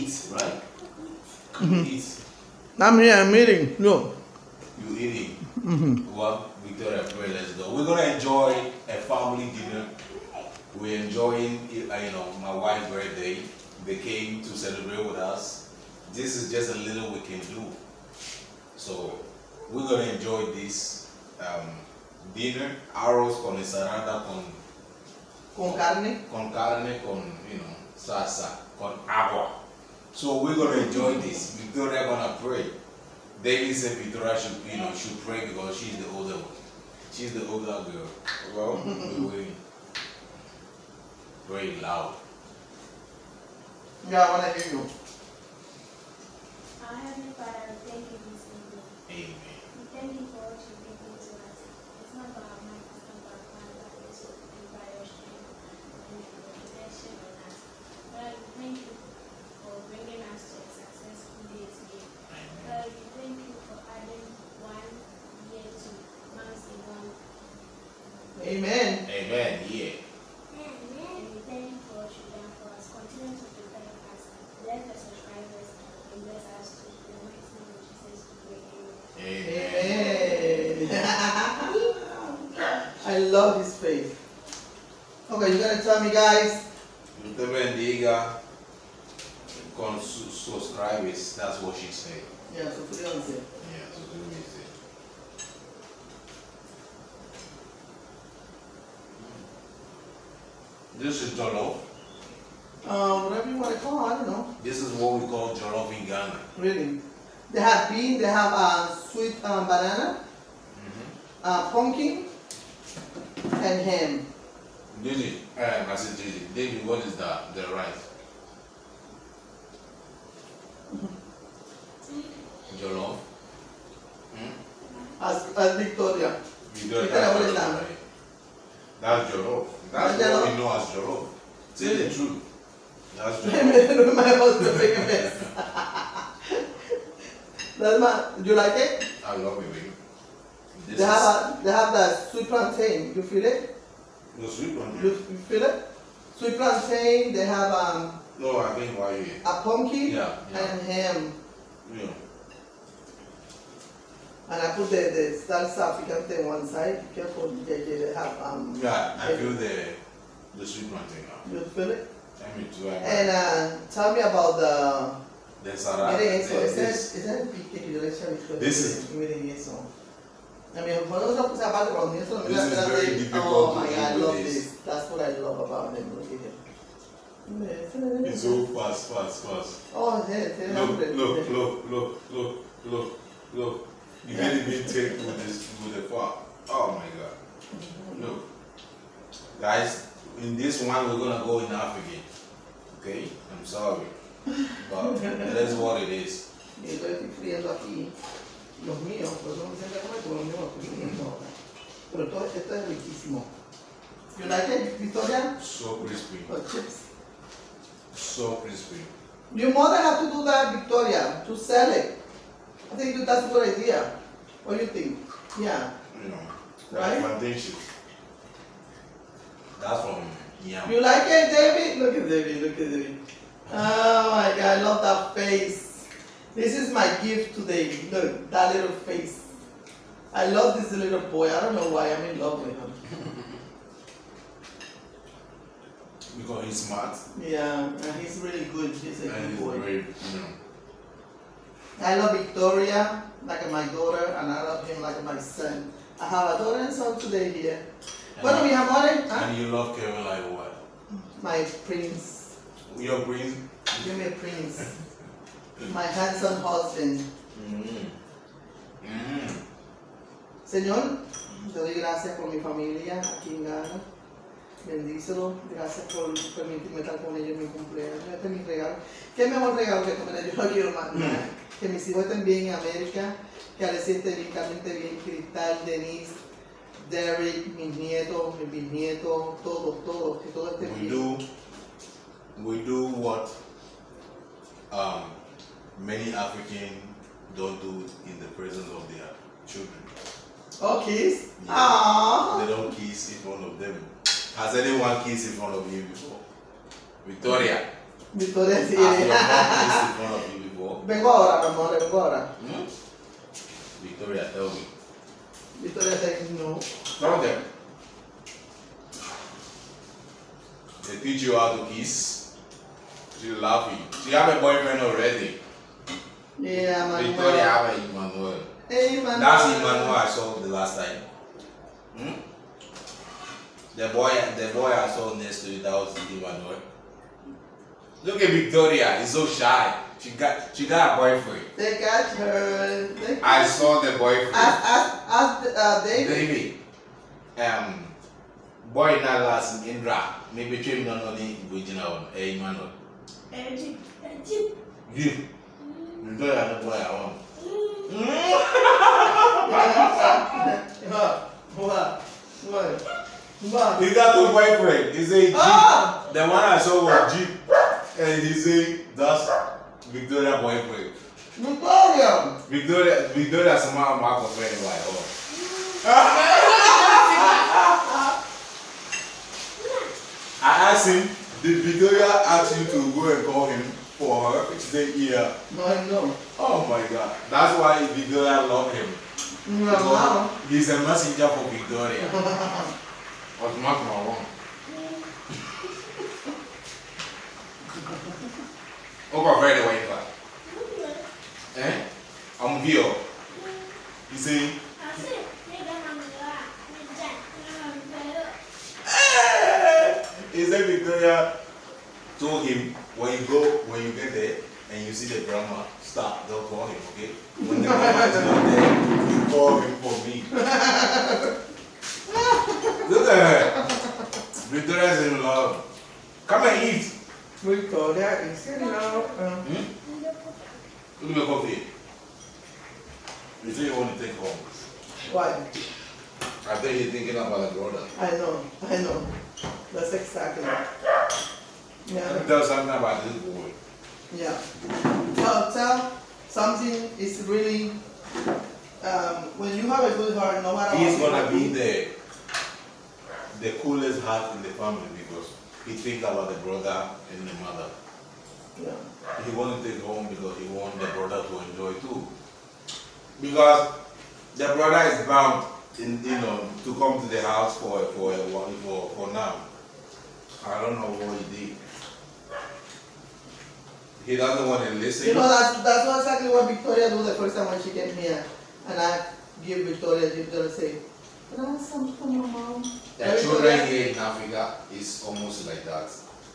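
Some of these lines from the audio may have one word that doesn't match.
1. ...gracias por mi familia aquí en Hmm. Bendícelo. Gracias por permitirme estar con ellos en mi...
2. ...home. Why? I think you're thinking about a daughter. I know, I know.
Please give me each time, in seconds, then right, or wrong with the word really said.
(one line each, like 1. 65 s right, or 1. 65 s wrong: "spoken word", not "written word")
1. 261 s wrong: "Ghana", not "Hmm"
2. 424 s wrong: "brother", not "daughter".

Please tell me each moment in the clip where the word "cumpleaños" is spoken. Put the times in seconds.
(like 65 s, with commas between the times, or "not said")
267 s.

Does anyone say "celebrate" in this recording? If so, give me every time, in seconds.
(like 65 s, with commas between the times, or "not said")
14 s.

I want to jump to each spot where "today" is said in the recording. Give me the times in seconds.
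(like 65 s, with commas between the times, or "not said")
227 s, 247 s.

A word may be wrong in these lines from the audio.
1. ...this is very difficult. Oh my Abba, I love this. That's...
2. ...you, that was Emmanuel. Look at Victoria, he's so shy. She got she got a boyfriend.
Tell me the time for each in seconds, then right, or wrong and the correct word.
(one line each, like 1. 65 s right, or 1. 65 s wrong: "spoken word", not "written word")
1. 172 s wrong: "God", not "Abba"
2. 325 s right.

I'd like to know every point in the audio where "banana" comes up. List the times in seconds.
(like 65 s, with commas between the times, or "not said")
109 s.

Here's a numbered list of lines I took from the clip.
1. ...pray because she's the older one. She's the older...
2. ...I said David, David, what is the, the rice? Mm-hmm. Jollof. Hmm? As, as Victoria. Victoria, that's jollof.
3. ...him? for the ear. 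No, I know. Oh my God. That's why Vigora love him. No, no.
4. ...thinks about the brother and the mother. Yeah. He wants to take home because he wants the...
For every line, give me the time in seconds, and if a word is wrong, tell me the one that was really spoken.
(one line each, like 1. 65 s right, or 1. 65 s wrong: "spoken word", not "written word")
1. 35 s right
2. 115 s right
3. 373 s right
4. 445 s right.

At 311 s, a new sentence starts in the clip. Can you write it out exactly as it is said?
They teach you how to kiss.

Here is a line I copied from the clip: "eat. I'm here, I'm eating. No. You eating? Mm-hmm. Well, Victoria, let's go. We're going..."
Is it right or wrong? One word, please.
right.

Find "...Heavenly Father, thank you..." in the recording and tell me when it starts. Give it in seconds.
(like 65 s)
46 s.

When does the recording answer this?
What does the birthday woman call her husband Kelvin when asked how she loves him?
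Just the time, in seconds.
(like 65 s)
251 s.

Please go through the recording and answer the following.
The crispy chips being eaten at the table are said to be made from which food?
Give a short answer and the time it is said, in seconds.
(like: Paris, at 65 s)
Yam, at 219 s.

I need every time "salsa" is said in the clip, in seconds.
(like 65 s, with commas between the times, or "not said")
27 s, 155 s.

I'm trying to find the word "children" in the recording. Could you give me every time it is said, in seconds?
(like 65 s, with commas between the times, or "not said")
289 s, 473 s.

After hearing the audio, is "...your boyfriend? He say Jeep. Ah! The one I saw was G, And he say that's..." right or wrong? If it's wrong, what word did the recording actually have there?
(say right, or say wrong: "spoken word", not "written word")
right.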